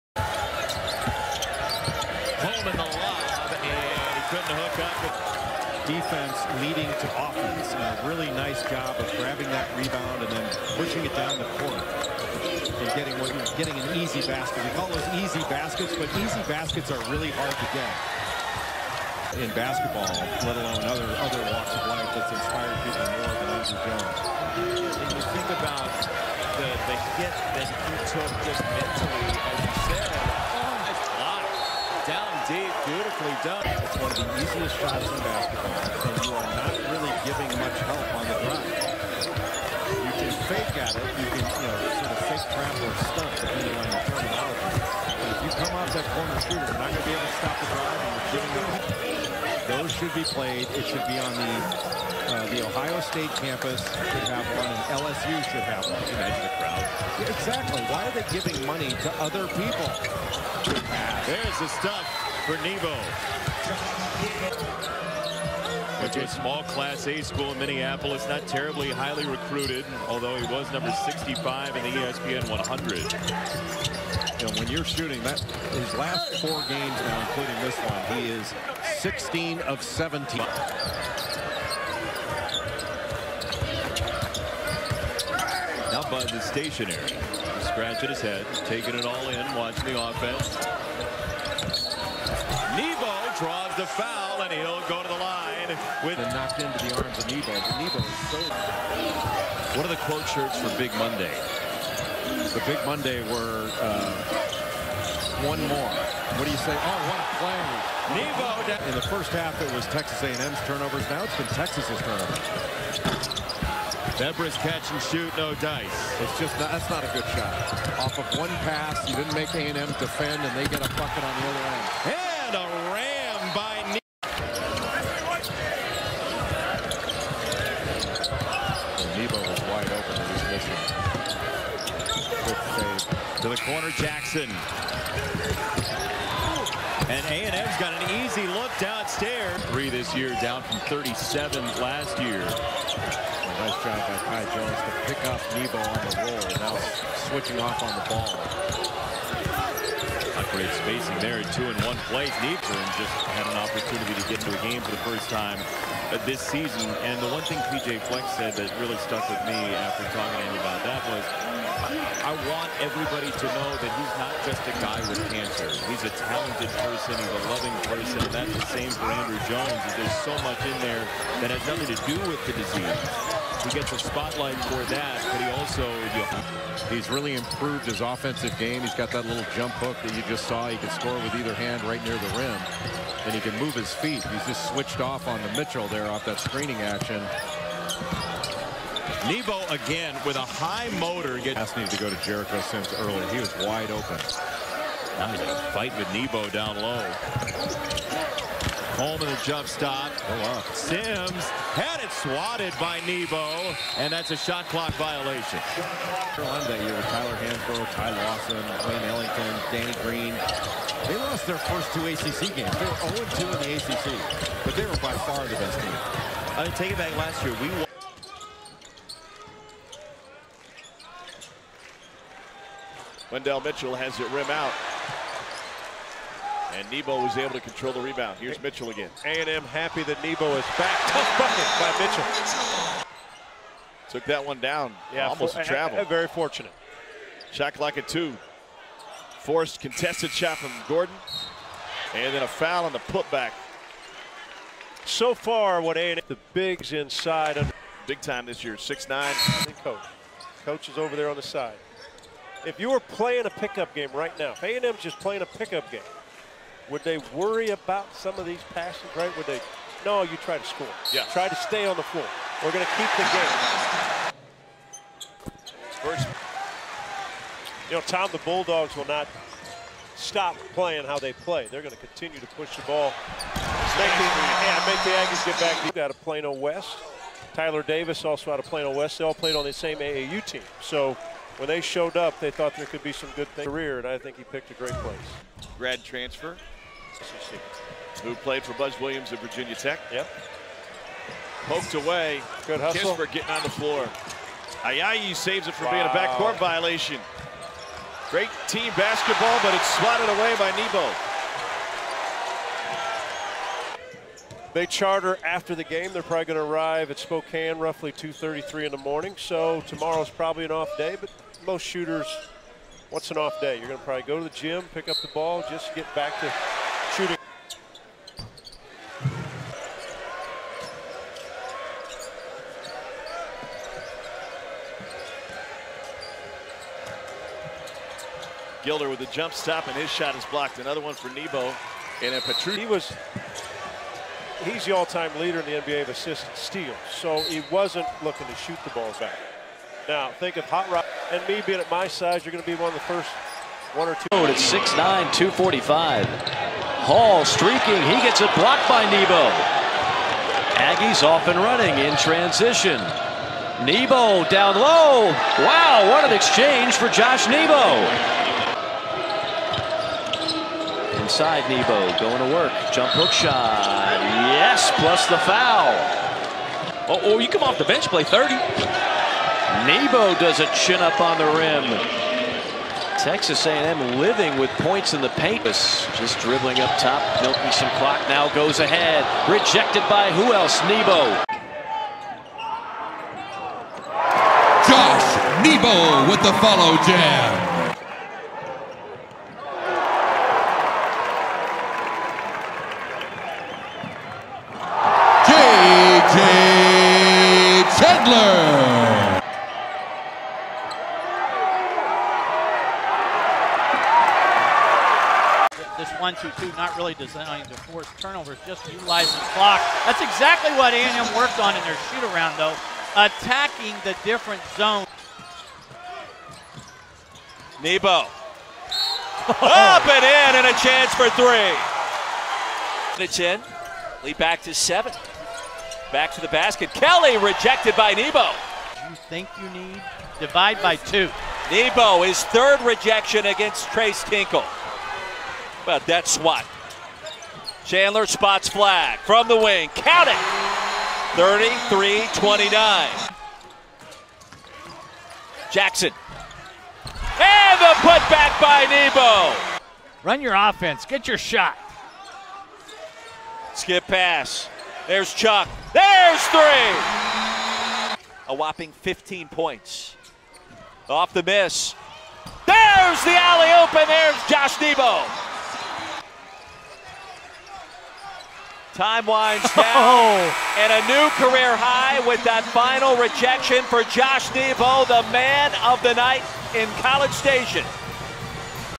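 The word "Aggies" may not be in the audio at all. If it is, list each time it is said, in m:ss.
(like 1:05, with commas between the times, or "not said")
4:35, 5:50.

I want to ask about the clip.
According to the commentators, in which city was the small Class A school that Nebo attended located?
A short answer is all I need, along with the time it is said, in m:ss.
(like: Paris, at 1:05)
Minneapolis, at 1:07.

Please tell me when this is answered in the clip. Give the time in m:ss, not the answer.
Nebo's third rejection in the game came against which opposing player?
7:13.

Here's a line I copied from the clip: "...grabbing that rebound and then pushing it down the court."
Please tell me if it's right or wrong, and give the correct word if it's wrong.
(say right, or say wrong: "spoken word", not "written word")
right.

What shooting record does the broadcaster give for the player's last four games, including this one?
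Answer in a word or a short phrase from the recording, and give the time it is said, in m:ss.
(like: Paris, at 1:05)
16 of 17, at 1:18.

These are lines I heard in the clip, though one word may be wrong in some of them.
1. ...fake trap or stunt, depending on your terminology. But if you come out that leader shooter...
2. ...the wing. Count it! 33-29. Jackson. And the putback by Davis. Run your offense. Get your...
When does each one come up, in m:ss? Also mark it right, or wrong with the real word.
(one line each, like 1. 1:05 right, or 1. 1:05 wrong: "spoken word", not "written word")
1. 0:42 wrong: "corner", not "leader"
2. 7:19 wrong: "Nebo", not "Davis".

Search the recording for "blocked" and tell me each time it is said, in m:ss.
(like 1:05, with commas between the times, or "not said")
5:30, 5:48.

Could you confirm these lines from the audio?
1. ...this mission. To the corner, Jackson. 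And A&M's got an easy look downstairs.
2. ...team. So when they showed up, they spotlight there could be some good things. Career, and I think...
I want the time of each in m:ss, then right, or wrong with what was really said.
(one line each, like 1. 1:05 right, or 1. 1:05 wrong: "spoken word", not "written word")
1. 2:10 right
2. 4:40 wrong: "thought", not "spotlight".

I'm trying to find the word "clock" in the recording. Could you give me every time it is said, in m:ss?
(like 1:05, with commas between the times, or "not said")
3:24, 6:17, 6:49.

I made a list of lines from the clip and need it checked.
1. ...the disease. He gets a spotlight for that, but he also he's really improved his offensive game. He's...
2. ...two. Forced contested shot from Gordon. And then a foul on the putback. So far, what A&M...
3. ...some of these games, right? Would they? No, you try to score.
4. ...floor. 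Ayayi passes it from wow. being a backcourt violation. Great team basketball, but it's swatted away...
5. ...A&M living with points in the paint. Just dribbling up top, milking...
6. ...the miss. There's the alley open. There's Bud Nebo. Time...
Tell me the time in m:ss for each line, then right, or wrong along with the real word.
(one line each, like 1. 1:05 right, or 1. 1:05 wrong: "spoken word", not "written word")
1. 2:52 right
2. 3:58 right
3. 4:18 wrong: "passes", not "games"
4. 4:53 wrong: "saves", not "passes"
5. 6:13 right
6. 7:41 wrong: "Josh", not "Bud".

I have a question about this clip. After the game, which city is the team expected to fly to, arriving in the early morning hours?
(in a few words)
Spokane.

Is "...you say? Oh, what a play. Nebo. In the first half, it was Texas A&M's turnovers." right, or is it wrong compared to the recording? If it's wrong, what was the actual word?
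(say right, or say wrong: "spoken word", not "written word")
right.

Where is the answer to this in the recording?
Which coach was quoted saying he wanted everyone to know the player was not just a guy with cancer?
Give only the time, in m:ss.
2:37.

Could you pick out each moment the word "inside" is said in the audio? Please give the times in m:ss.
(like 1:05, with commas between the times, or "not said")
4:06, 6:01.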